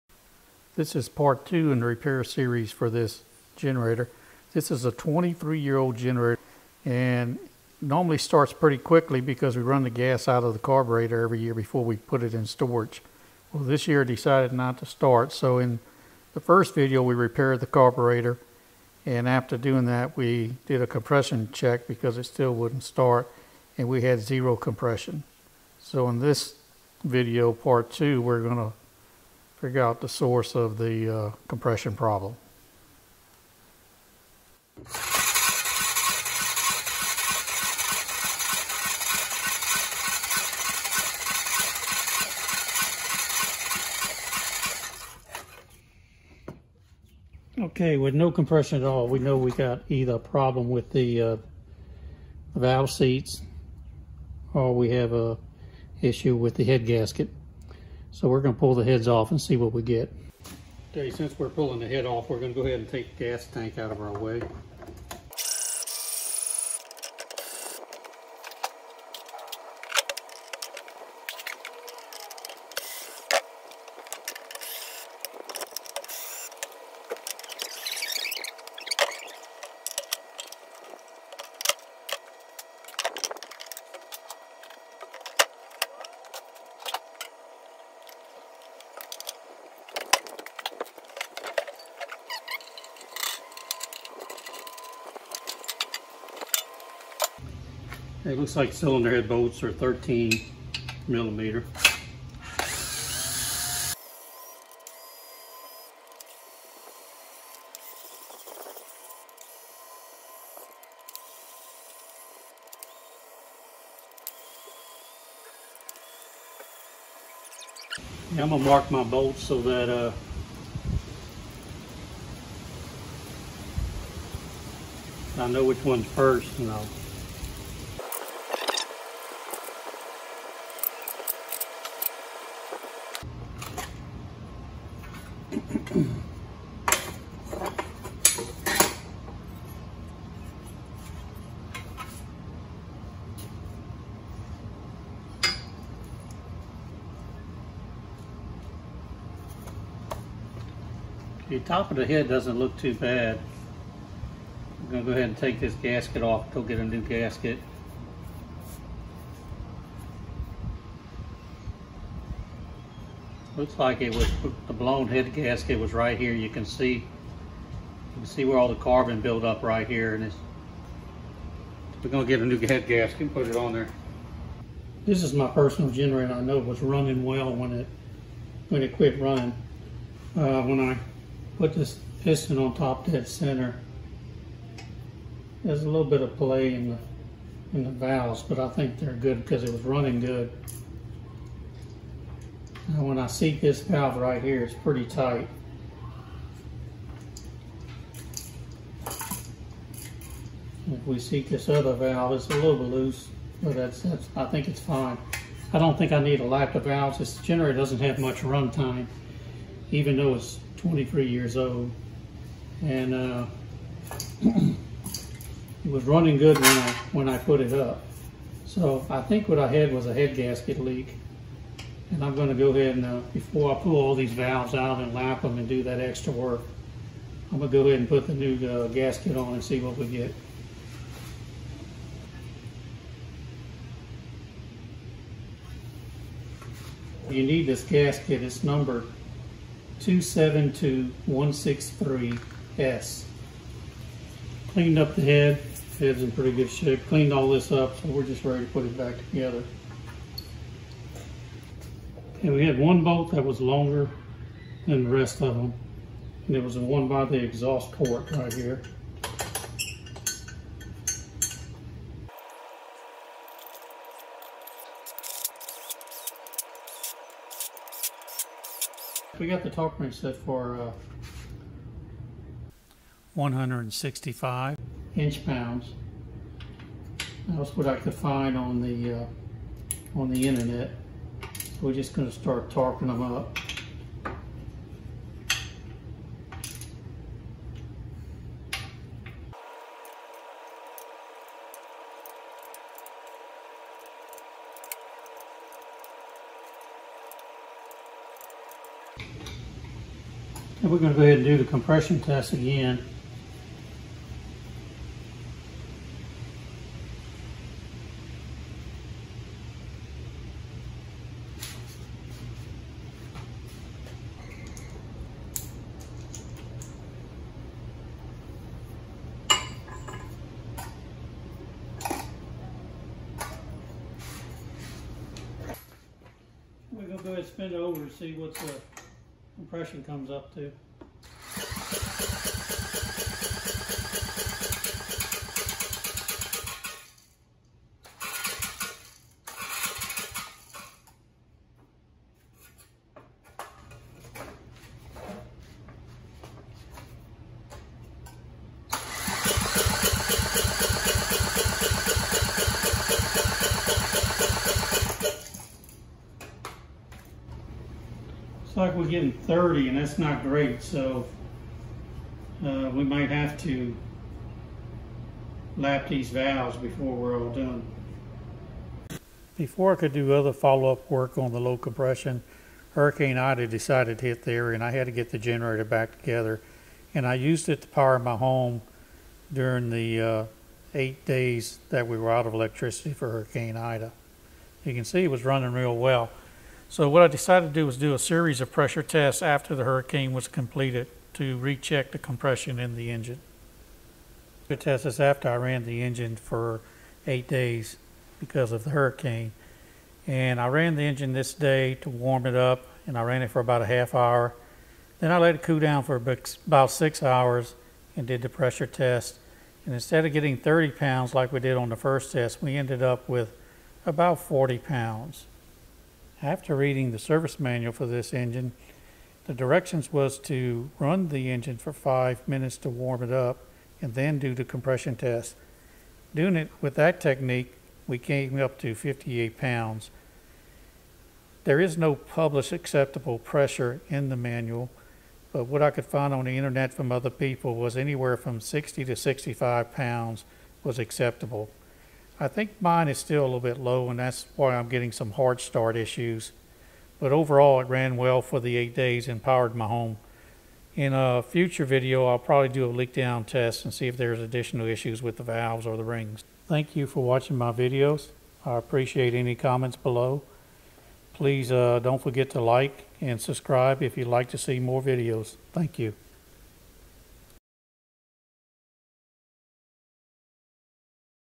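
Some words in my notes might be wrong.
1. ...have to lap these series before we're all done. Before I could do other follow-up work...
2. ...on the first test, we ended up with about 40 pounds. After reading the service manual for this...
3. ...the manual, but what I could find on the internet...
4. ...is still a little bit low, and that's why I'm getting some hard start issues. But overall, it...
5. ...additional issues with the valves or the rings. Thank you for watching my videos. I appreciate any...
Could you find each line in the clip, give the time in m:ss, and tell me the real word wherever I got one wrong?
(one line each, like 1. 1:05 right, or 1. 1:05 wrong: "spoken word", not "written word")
1. 6:03 wrong: "valves", not "series"
2. 6:51 right
3. 7:14 right
4. 7:23 right
5. 7:34 right.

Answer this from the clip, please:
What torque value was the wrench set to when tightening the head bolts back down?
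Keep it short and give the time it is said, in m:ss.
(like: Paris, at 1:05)
165 inch pounds, at 4:33.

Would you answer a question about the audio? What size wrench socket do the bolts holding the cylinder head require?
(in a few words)
13 millimeter.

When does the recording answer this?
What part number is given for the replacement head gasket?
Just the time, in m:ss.
4:00.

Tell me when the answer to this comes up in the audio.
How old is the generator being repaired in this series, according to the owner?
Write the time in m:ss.
0:04.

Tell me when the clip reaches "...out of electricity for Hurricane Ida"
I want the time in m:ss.
6:22.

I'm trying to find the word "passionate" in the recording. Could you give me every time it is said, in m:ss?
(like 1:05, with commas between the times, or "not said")
not said.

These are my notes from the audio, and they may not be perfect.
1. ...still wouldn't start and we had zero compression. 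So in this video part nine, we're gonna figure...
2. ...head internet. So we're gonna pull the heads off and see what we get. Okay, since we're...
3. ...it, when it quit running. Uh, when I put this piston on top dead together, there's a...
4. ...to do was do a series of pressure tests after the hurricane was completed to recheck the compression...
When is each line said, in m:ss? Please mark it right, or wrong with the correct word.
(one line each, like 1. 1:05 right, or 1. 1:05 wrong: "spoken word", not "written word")
1. 0:22 wrong: "two", not "nine"
2. 0:56 wrong: "gasket", not "internet"
3. 2:57 wrong: "center", not "together"
4. 6:27 right.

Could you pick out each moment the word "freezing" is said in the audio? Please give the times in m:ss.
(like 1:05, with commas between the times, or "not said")
not said.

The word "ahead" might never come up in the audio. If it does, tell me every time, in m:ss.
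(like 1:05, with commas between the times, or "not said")
1:02, 2:35, 3:42, 3:47, 5:01, 5:27.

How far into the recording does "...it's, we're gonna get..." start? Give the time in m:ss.
2:50.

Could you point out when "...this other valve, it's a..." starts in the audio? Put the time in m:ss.
3:21.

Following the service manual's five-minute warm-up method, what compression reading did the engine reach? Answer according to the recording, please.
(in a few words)
58 pounds.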